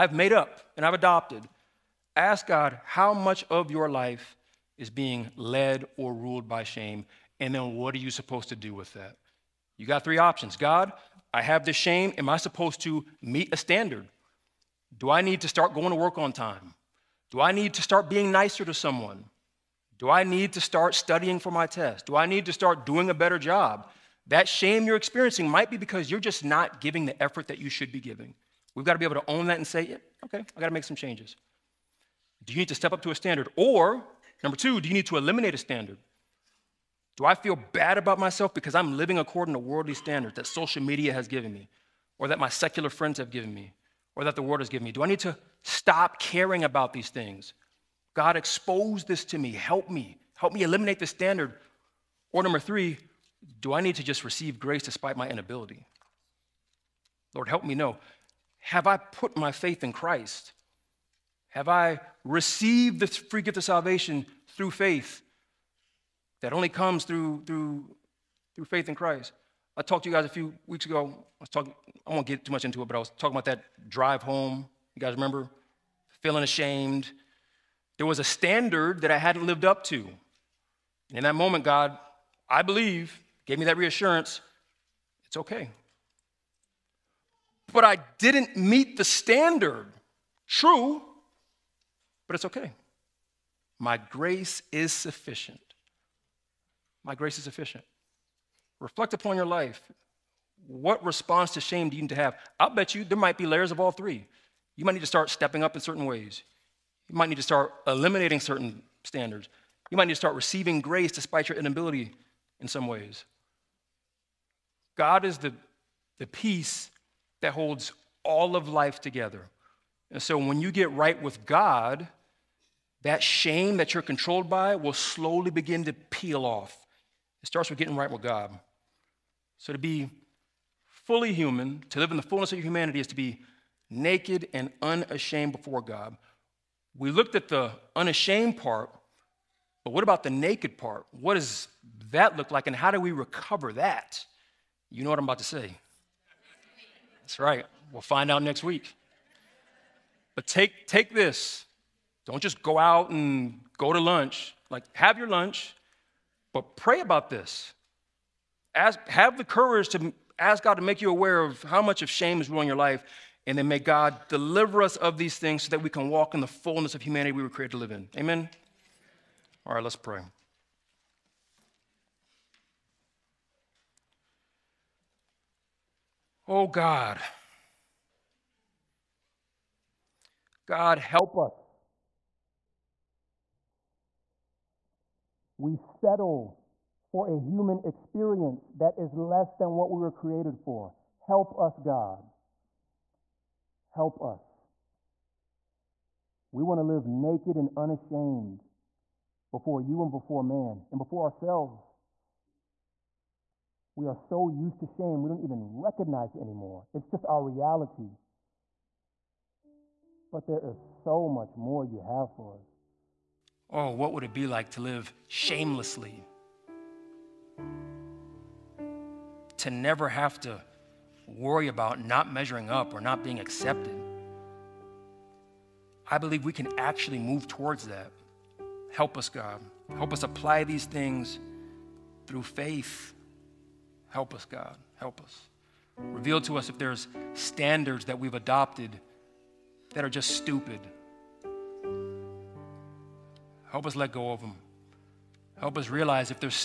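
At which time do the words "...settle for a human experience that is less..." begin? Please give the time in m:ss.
3:05.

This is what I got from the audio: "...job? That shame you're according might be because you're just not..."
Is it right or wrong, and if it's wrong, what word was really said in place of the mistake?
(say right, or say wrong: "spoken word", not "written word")
wrong: "experiencing", not "according".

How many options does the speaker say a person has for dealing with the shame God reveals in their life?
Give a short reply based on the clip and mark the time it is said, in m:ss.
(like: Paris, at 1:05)
3, at 0:10.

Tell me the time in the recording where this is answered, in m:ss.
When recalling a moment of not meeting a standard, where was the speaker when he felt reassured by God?
1:13.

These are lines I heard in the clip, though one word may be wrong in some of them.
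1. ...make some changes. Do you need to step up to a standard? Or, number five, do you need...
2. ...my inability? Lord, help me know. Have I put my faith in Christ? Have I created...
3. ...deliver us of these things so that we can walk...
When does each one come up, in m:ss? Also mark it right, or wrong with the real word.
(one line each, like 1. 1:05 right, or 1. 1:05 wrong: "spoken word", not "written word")
1. 0:30 wrong: "two", not "five"
2. 0:55 wrong: "received", not "created"
3. 2:44 right.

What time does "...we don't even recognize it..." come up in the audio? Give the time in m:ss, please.
3:25.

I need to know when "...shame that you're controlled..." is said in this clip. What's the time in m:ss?
2:03.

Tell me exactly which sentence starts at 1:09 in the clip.
I talked to you guys a few weeks ago.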